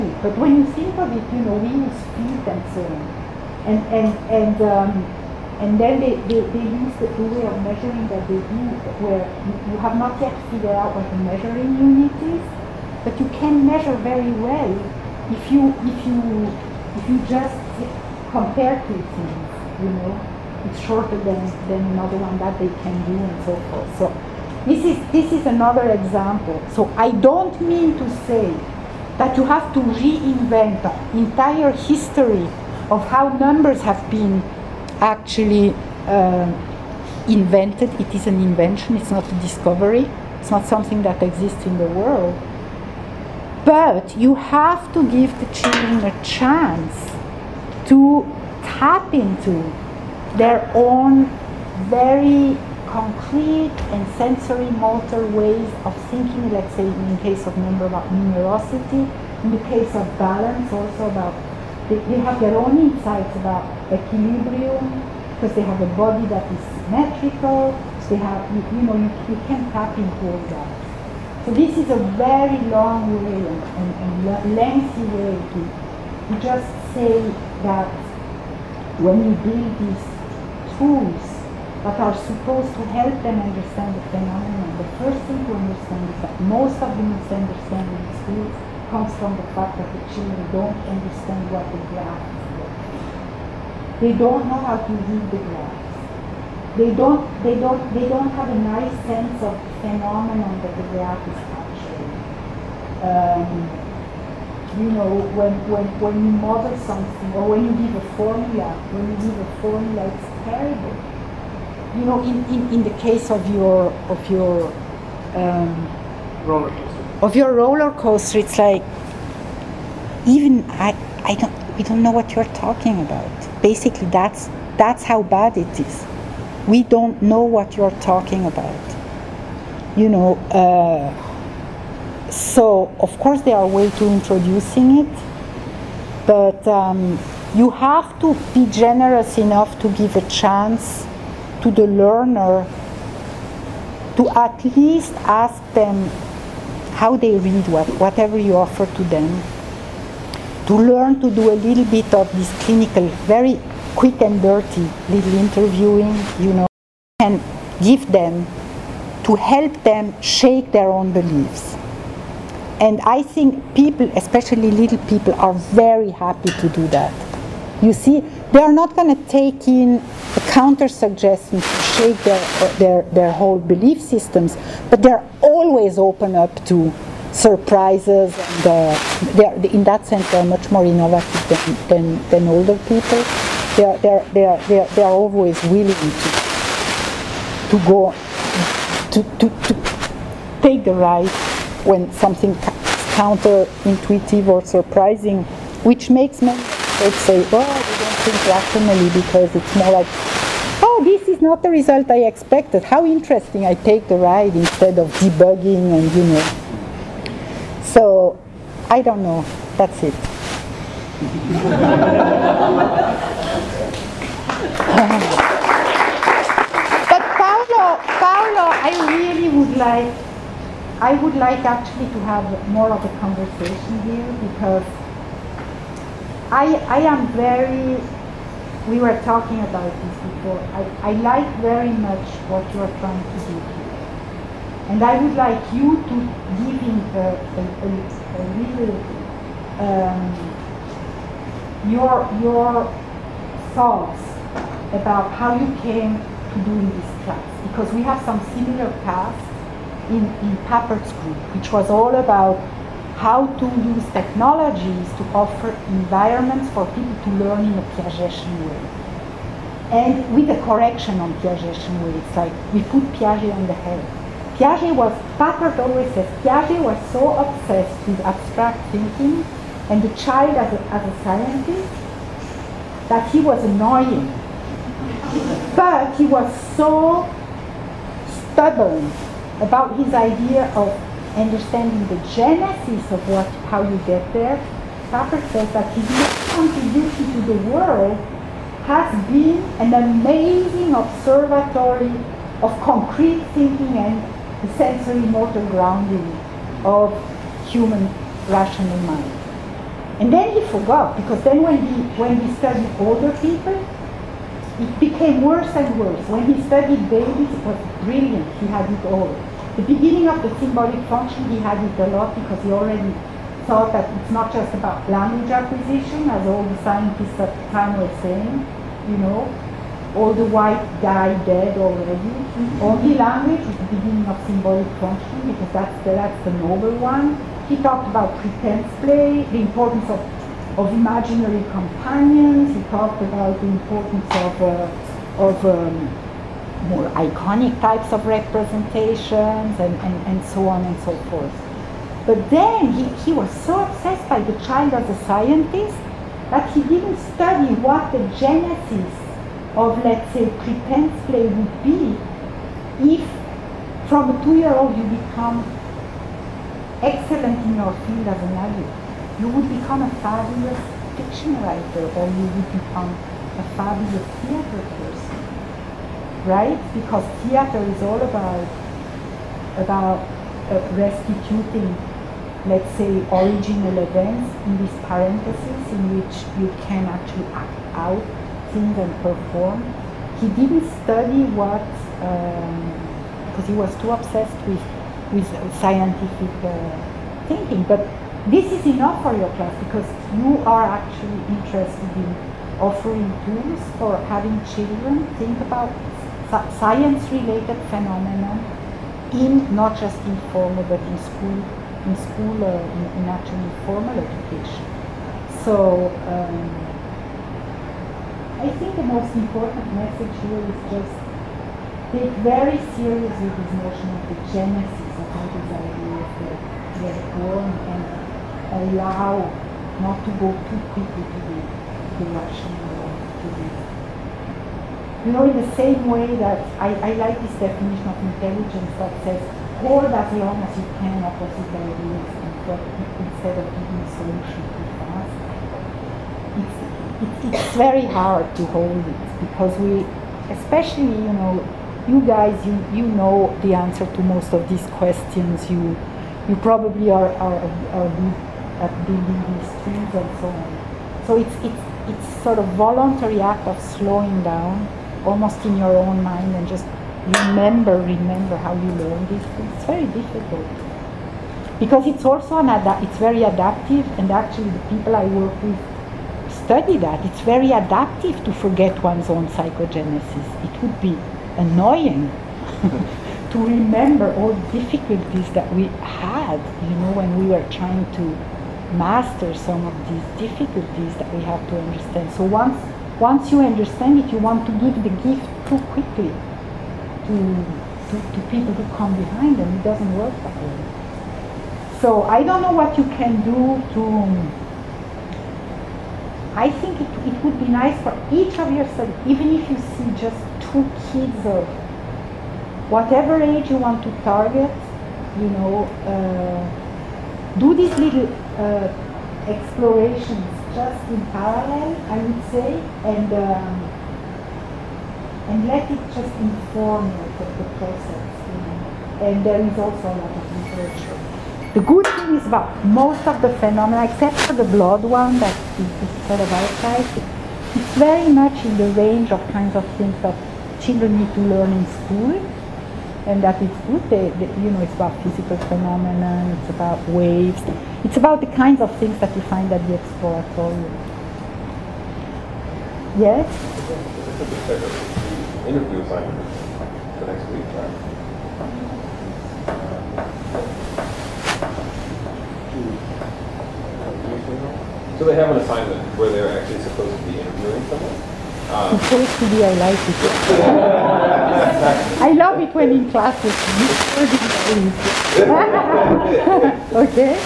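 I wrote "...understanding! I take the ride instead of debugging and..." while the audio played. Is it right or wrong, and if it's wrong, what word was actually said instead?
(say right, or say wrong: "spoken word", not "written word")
wrong: "interesting", not "understanding".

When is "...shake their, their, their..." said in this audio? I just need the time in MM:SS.
02:51.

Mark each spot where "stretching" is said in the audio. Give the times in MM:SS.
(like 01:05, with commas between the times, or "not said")
not said.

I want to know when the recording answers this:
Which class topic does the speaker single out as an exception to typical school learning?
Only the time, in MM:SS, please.
08:44.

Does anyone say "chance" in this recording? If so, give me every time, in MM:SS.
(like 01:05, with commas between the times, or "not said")
00:46, 02:20.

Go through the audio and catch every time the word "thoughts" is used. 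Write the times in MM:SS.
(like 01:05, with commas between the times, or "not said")
04:03, 05:13.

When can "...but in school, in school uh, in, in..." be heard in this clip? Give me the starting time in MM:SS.
06:40.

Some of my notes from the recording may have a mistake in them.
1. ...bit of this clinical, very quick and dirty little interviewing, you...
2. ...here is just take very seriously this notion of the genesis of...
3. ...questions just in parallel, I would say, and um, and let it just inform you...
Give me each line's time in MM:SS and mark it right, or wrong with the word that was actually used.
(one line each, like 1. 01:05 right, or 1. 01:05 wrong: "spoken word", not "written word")
1. 02:31 right
2. 06:50 right
3. 08:29 wrong: "explorations", not "questions".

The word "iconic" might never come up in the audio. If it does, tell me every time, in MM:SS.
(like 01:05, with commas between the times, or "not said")
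05:37.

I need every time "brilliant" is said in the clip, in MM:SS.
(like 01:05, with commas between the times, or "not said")
05:08.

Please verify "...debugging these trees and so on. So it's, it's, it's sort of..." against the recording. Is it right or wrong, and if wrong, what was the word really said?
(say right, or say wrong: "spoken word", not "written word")
wrong: "building", not "debugging".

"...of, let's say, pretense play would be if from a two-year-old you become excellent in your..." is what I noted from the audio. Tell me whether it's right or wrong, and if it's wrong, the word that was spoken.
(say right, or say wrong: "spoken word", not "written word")
right.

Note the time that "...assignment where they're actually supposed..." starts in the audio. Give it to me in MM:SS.
09:15.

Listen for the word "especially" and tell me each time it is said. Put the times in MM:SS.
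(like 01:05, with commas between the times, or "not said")
02:44, 07:20.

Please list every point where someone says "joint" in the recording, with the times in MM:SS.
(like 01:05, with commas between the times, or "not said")
not said.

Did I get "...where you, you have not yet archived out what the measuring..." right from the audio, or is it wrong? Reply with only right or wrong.
wrong.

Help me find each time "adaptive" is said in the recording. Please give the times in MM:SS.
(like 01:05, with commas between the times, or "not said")
07:43, 07:47.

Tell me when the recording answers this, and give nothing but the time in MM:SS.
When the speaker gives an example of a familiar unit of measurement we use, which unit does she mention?
00:02.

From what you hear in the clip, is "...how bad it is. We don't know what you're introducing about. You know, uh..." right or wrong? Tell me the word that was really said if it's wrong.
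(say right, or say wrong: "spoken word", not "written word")
wrong: "talking", not "introducing".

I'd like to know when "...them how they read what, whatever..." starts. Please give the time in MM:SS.
02:25.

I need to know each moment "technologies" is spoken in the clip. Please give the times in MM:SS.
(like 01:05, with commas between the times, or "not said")
04:14.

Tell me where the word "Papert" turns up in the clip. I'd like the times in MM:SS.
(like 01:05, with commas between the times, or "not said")
04:10, 04:25, 04:45.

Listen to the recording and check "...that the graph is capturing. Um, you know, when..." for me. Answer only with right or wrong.
right.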